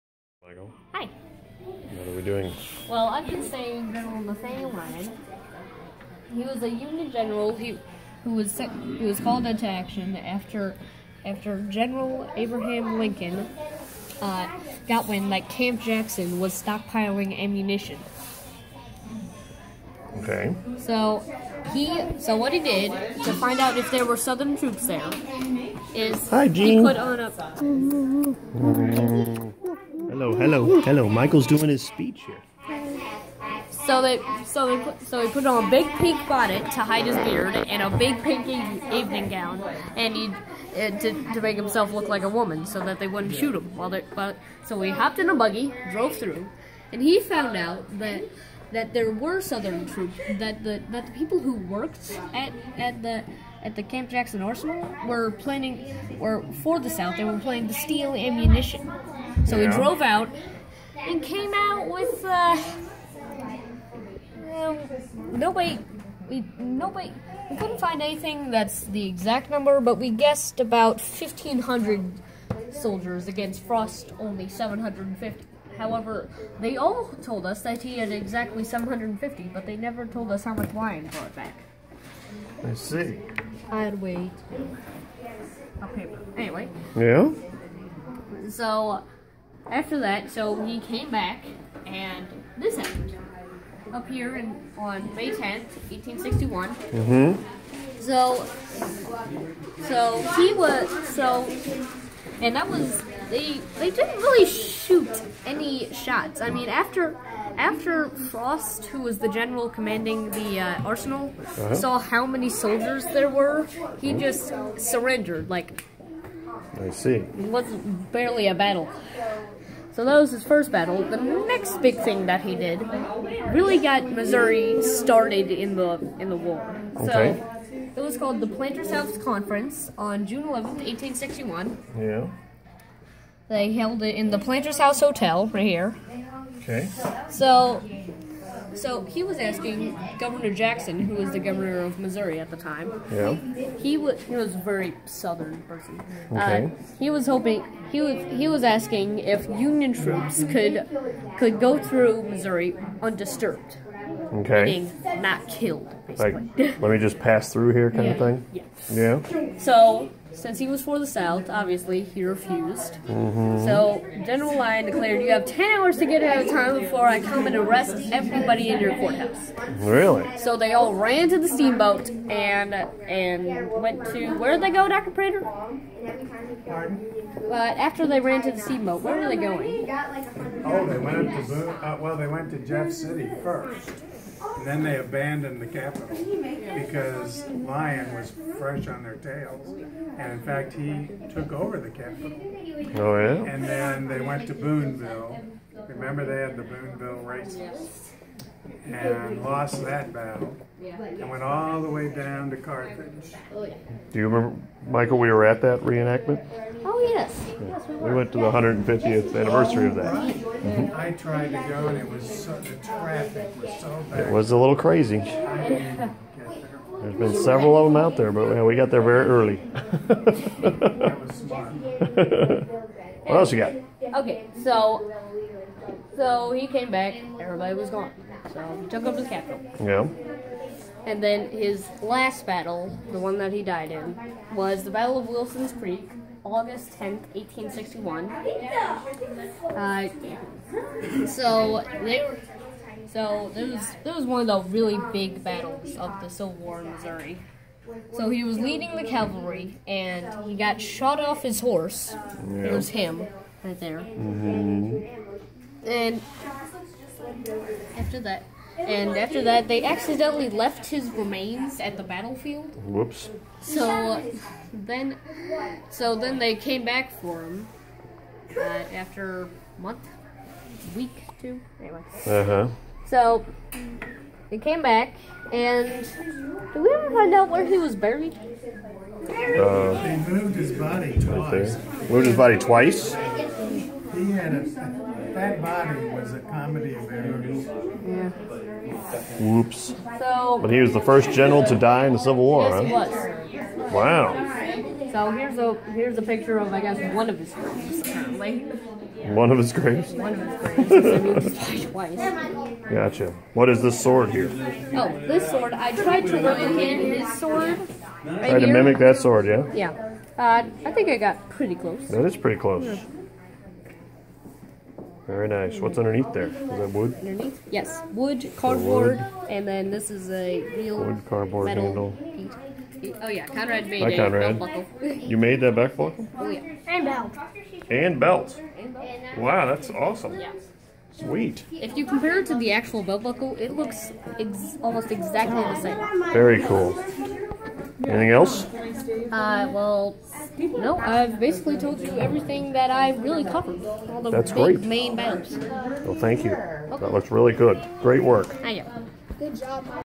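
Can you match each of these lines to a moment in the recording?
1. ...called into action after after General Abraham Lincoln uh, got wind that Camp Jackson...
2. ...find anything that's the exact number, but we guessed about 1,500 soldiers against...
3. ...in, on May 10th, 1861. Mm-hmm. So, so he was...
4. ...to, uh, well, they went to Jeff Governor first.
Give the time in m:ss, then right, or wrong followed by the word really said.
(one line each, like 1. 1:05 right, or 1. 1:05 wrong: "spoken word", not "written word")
1. 0:09 right
2. 1:07 right
3. 1:34 right
4. 3:01 wrong: "City", not "Governor".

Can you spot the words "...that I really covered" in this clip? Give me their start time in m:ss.
5:42.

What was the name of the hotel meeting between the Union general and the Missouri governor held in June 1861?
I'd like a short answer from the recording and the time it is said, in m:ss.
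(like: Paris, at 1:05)
Planters House Conference, at 2:08.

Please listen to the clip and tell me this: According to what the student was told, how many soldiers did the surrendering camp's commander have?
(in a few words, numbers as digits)
750.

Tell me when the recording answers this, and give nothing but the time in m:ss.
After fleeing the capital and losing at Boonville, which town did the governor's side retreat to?
3:22.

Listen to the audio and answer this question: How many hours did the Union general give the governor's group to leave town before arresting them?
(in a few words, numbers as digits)
10.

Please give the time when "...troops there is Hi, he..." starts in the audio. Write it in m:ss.
0:24.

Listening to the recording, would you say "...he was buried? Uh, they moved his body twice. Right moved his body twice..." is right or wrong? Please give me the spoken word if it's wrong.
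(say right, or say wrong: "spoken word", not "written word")
right.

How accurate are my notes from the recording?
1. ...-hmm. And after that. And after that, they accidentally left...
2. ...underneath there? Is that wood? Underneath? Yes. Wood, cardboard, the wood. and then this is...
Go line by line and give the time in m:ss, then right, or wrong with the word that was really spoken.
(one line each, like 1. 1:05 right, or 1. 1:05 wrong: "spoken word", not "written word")
1. 4:14 right
2. 5:15 right.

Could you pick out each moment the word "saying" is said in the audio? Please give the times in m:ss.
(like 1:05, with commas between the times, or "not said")
0:03.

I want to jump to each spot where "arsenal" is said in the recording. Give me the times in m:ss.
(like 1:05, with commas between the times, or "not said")
0:54, 1:50.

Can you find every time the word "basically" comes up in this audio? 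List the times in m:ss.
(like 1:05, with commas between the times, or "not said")
2:36, 5:41.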